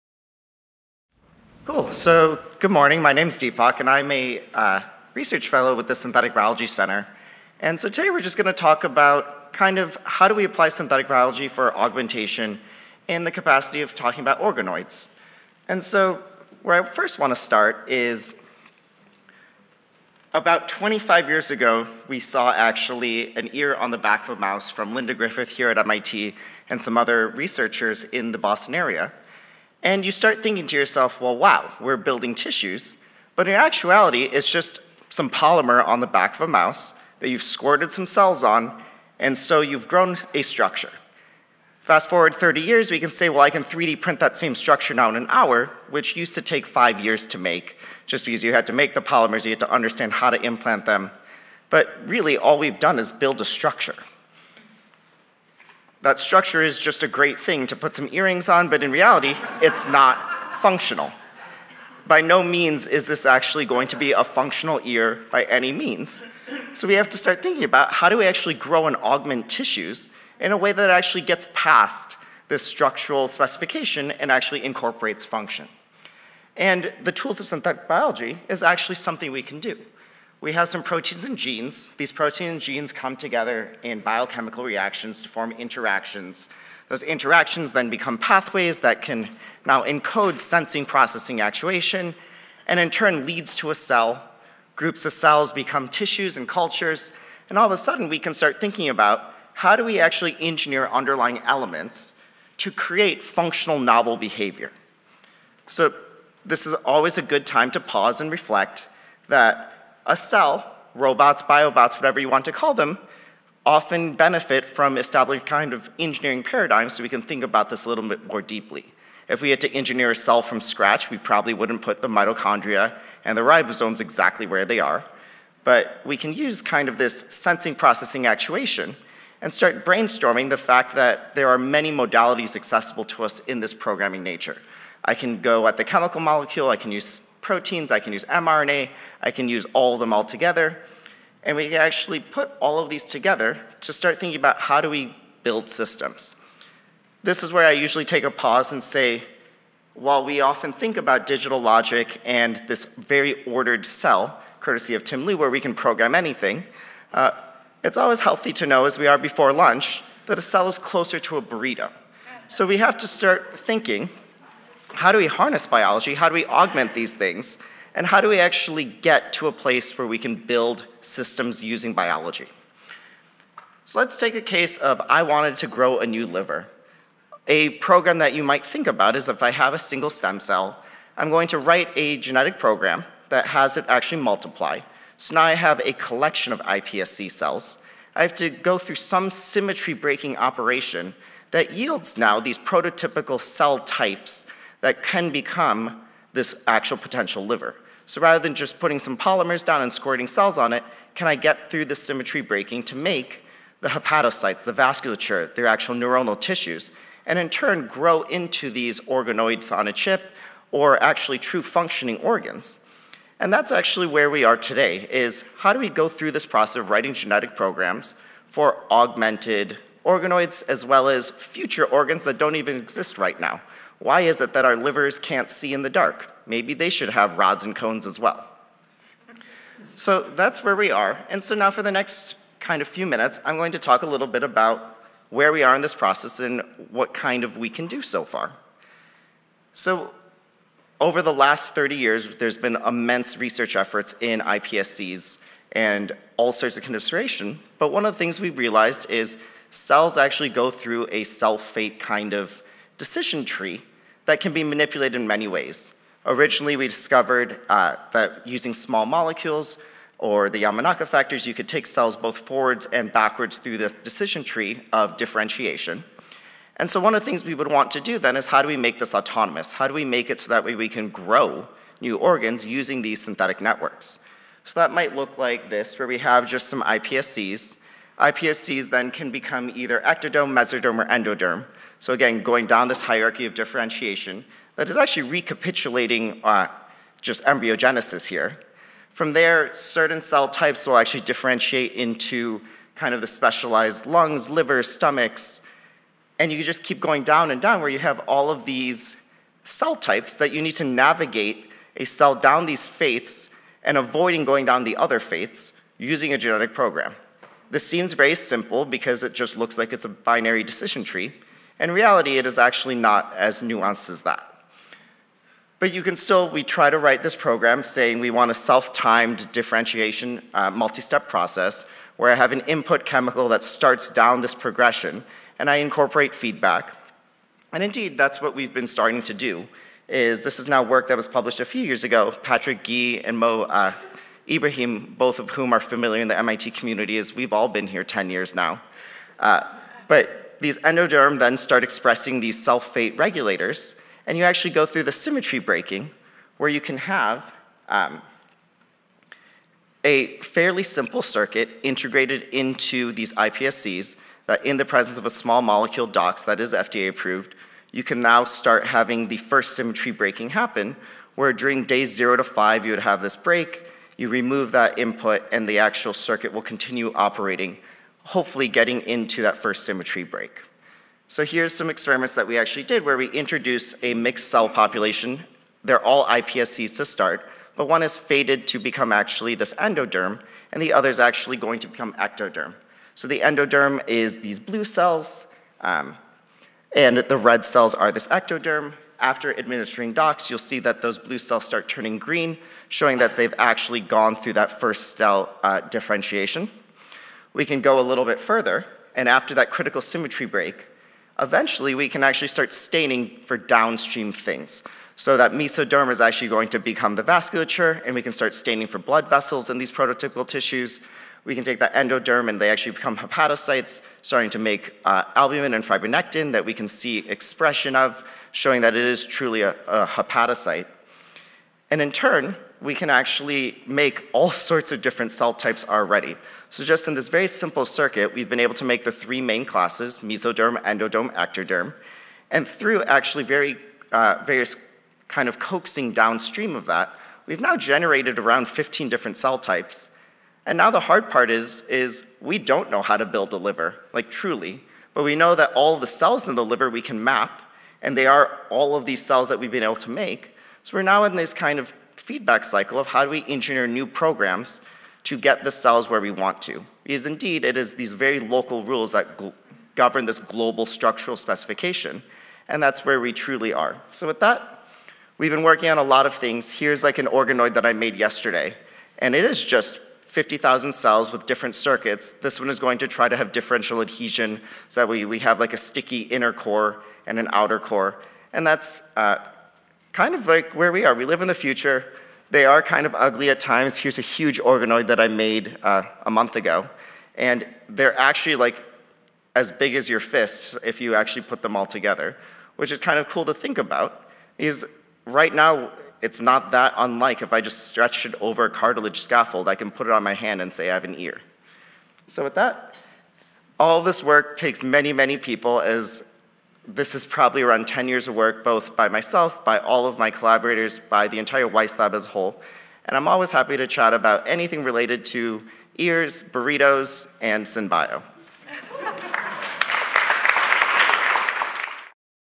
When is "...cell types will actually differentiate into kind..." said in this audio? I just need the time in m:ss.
4:50.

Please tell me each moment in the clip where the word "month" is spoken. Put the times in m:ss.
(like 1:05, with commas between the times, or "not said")
8:06.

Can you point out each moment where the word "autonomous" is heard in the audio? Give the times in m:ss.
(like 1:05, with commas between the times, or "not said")
4:29.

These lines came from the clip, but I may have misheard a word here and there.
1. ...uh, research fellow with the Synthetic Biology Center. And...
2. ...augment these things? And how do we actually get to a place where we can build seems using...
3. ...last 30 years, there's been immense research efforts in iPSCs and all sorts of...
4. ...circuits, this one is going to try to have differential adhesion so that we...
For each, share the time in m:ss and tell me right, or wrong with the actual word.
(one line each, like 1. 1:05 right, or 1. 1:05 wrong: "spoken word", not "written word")
1. 0:04 right
2. 2:46 wrong: "systems", not "seems"
3. 4:01 right
4. 7:51 right.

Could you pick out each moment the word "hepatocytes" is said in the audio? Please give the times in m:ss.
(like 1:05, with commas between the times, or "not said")
3:23, 6:53, 7:00.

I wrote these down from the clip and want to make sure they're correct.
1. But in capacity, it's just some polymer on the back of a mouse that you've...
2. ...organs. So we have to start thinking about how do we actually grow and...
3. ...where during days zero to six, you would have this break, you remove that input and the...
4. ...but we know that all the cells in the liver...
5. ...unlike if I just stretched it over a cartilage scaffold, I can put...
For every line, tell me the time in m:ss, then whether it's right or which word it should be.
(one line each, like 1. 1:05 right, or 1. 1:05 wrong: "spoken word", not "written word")
1. 0:33 wrong: "actuality", not "capacity"
2. 1:05 wrong: "means", not "organs"
3. 6:01 wrong: "five", not "six"
4. 7:25 right
5. 8:16 right.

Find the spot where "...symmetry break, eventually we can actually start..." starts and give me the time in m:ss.
6:40.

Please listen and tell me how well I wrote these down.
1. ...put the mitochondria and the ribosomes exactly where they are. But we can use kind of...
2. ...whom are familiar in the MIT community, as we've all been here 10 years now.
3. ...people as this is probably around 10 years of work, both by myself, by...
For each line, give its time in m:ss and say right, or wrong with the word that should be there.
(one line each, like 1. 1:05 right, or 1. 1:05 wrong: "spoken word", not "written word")
1. 2:01 right
2. 5:35 right
3. 8:25 right.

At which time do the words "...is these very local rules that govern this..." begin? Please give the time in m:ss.
7:37.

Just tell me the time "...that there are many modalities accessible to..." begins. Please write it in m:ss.
2:10.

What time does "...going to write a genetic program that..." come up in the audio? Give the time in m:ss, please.
3:01.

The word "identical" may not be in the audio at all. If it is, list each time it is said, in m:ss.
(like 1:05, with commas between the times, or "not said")
not said.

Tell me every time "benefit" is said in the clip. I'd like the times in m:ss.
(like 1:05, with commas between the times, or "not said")
1:54.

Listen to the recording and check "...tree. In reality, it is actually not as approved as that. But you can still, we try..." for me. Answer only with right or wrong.
wrong.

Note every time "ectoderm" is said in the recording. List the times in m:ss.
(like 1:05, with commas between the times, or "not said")
4:40, 6:22, 6:28, 7:11.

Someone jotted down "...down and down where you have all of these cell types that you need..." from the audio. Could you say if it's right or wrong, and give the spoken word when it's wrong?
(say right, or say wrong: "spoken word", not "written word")
right.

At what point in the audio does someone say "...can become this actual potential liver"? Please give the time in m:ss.
3:15.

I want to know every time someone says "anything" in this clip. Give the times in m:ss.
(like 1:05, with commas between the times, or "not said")
2:36, 8:34.